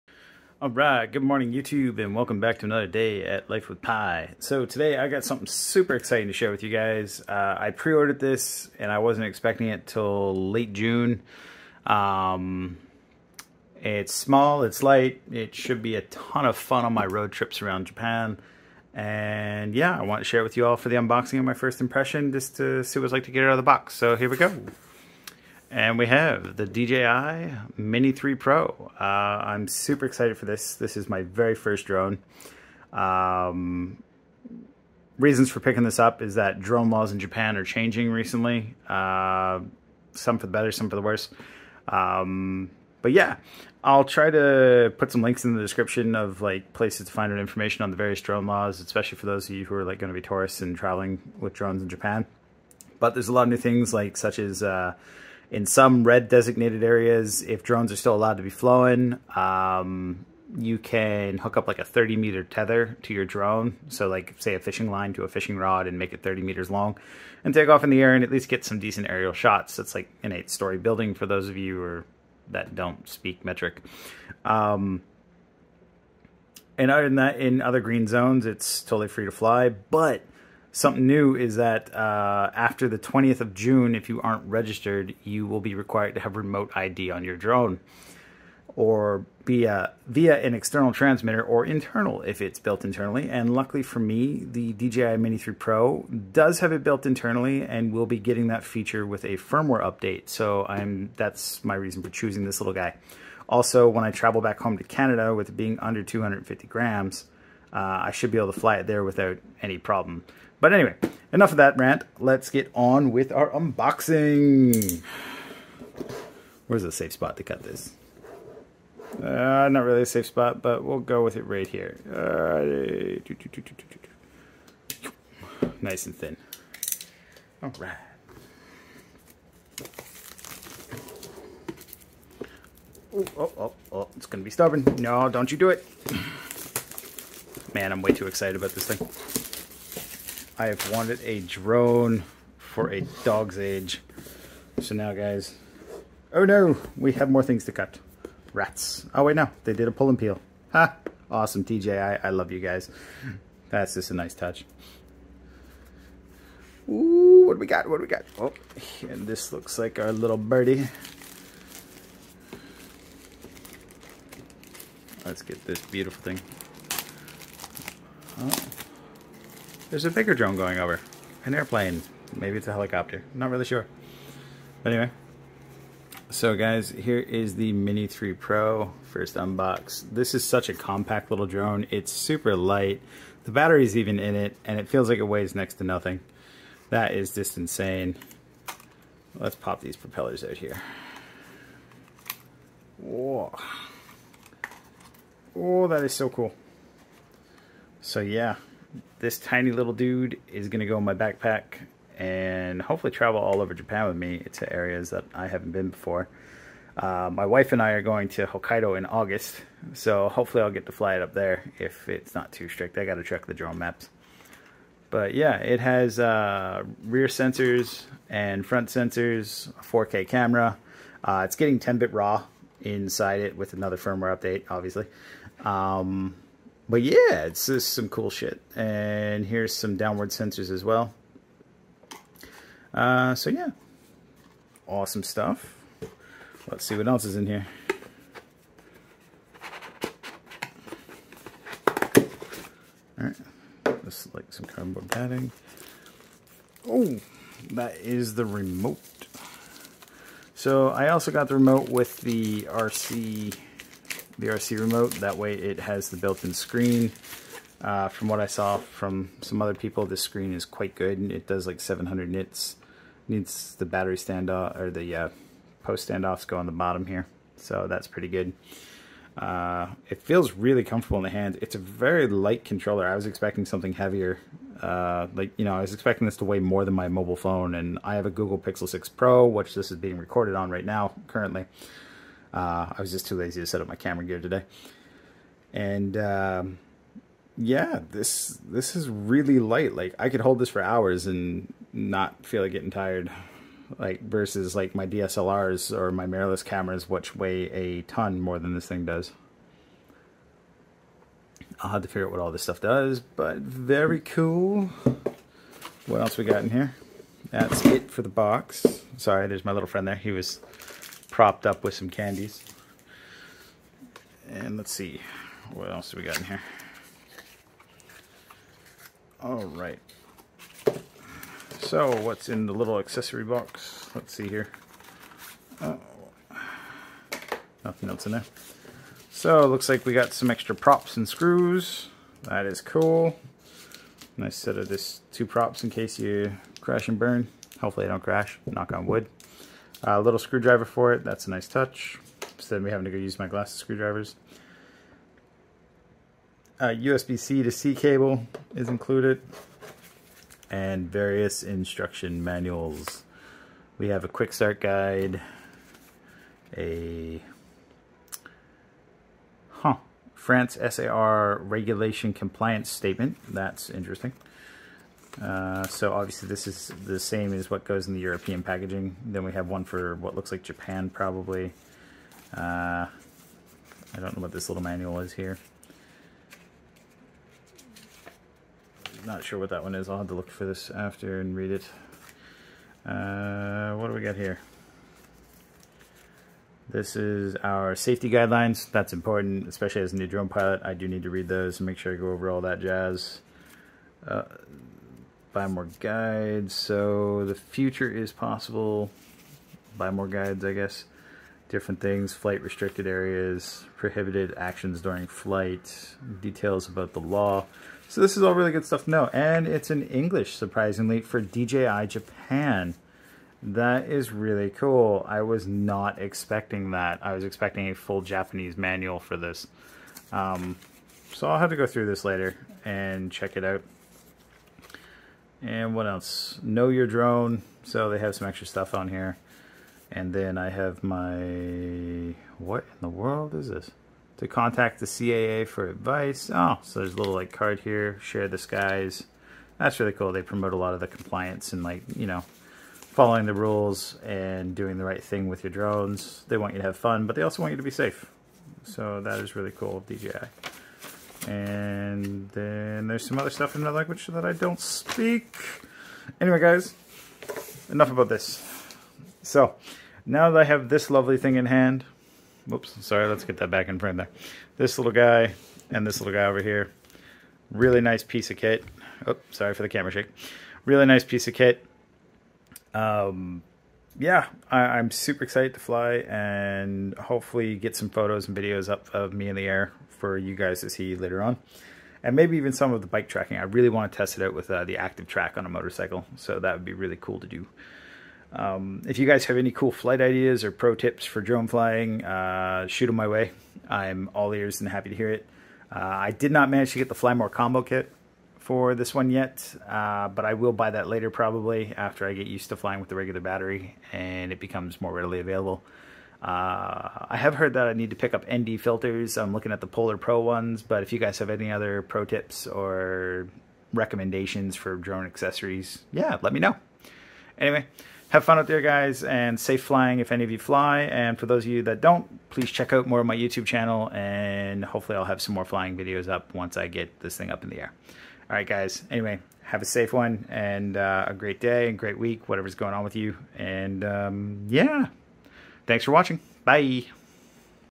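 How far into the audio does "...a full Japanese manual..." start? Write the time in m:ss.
6:57.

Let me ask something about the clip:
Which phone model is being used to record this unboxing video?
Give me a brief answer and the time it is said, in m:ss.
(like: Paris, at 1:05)
Google Pixel 6 Pro, at 4:38.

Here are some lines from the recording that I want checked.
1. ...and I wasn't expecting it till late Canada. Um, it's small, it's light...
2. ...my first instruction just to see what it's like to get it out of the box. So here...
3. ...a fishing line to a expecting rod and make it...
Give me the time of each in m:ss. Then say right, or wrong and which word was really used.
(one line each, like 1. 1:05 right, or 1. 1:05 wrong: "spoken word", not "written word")
1. 0:08 wrong: "June", not "Canada"
2. 0:21 wrong: "impression", not "instruction"
3. 1:04 wrong: "fishing", not "expecting".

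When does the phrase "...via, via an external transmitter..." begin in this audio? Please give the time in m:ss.
1:29.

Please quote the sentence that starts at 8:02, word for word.
And maybe even some of the bike tracking.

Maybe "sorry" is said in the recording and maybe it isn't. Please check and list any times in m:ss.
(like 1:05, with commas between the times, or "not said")
5:09, 7:43, 7:49.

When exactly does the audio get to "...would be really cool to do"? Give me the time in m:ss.
8:06.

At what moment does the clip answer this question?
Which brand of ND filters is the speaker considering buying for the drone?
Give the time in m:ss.
8:29.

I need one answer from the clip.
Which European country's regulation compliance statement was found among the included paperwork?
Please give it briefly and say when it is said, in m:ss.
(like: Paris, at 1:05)
France, at 6:00.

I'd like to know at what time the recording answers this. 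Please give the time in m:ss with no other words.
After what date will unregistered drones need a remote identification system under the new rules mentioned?
1:22.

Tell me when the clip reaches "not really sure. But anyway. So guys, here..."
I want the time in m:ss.
2:53.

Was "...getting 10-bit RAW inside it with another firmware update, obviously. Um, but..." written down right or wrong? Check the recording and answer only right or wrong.
right.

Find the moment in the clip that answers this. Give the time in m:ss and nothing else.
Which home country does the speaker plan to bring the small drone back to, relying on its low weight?
1:44.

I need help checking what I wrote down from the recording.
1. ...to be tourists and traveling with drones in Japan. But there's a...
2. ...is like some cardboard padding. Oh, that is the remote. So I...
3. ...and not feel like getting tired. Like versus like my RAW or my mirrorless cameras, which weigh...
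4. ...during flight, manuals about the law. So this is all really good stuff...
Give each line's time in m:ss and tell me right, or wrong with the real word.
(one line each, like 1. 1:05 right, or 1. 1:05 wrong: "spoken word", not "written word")
1. 0:50 right
2. 4:04 right
3. 4:51 wrong: "DSLRs", not "RAW"
4. 6:45 wrong: "details", not "manuals".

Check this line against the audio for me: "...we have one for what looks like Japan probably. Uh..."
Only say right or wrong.
right.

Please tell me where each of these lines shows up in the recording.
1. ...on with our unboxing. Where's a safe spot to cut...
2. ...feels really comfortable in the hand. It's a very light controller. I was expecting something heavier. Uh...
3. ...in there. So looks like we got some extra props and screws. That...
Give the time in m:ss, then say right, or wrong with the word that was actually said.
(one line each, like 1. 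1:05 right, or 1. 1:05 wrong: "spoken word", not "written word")
1. 1:52 right
2. 4:30 right
3. 5:28 right.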